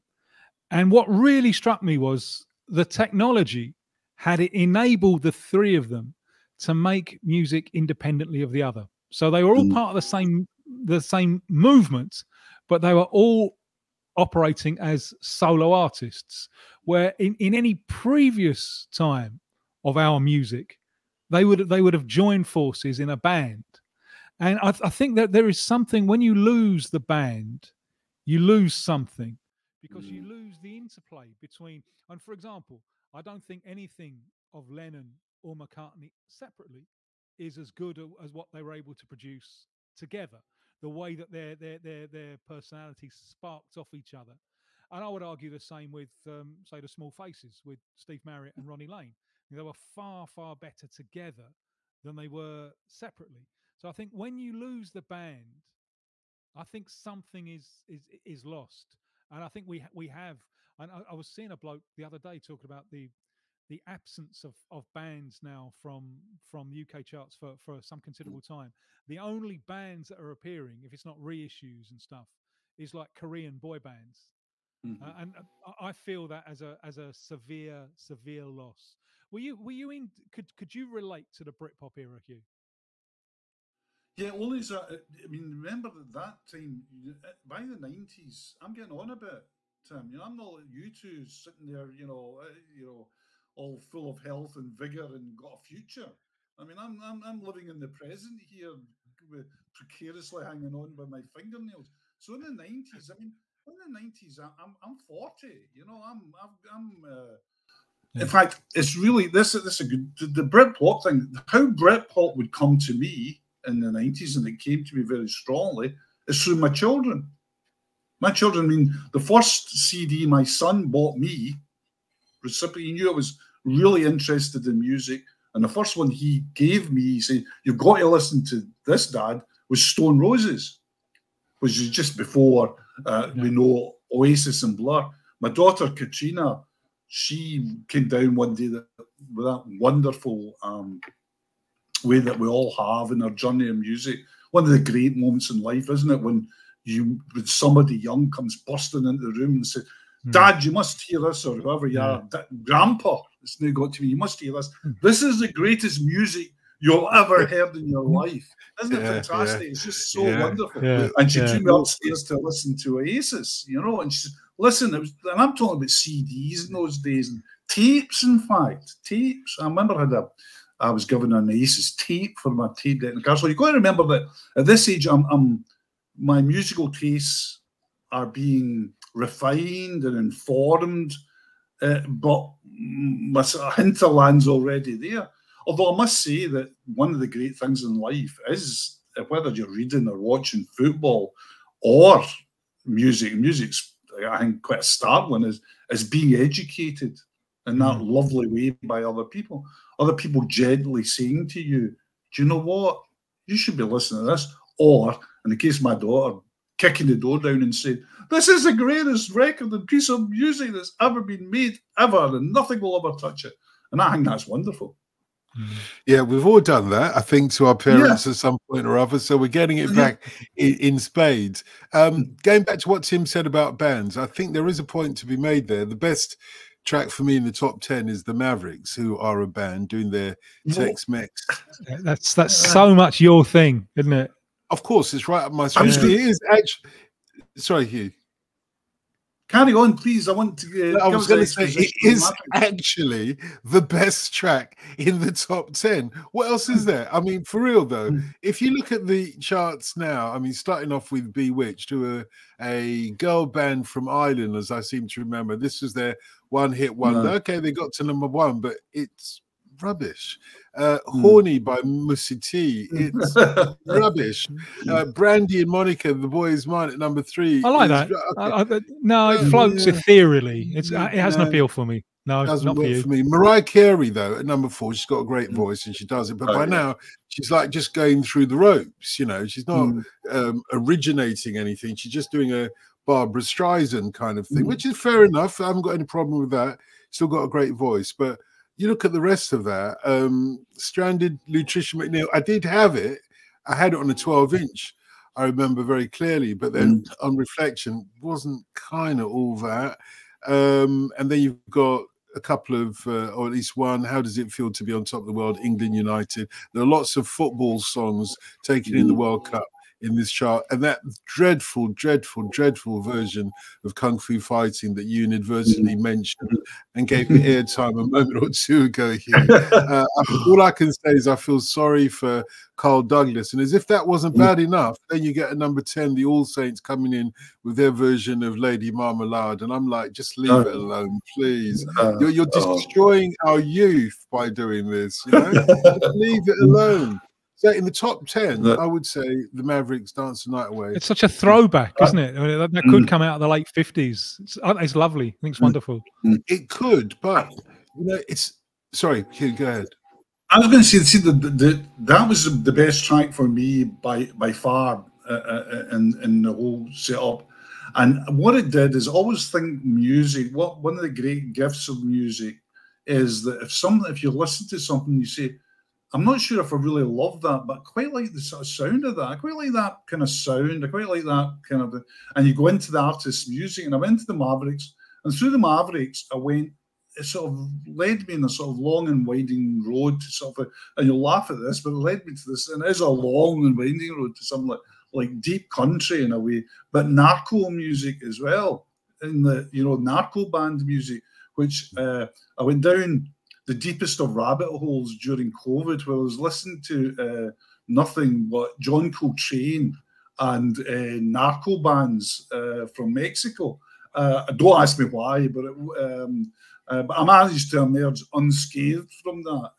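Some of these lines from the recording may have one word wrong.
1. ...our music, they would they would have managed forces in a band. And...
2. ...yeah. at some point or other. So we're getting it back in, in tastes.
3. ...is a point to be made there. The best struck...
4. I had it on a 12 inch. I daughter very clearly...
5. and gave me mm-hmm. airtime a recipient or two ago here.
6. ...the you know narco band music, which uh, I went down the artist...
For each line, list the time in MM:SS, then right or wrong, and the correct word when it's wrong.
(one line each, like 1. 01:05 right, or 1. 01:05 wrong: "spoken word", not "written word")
1. 00:19 wrong: "joined", not "managed"
2. 03:38 wrong: "spades", not "tastes"
3. 03:44 wrong: "track", not "struck"
4. 04:53 wrong: "remember", not "daughter"
5. 05:16 wrong: "moment", not "recipient"
6. 06:29 wrong: "deepest", not "artist".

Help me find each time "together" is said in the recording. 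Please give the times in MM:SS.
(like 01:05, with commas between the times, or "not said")
00:39, 00:50.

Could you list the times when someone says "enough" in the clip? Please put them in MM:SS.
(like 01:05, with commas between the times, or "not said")
04:45, 05:24.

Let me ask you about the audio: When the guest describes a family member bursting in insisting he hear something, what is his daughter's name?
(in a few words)
Katrina.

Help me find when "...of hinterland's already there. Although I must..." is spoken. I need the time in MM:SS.
03:03.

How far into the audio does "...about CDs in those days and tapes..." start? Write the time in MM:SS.
02:45.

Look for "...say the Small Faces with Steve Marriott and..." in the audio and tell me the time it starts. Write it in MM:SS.
00:46.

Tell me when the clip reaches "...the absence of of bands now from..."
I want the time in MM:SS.
01:03.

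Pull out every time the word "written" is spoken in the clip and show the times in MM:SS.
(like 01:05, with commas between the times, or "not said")
not said.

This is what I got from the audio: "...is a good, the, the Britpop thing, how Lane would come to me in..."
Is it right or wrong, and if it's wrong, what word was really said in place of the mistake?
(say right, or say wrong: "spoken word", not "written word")
wrong: "Britpop", not "Lane".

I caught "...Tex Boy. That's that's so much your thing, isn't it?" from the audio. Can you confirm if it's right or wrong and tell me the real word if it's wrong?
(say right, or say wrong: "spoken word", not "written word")
wrong: "Mex", not "Boy".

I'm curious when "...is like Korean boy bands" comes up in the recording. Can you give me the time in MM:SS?
01:12.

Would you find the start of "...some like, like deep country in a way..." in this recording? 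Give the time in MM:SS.
06:24.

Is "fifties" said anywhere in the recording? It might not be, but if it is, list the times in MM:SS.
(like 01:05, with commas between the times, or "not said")
05:43.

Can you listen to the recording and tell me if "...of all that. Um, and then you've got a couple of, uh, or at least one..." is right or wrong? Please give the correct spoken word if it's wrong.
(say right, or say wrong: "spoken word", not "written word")
right.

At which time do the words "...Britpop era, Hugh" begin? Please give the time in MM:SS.
01:21.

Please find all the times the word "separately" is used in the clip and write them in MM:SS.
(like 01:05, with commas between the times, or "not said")
00:36, 00:52.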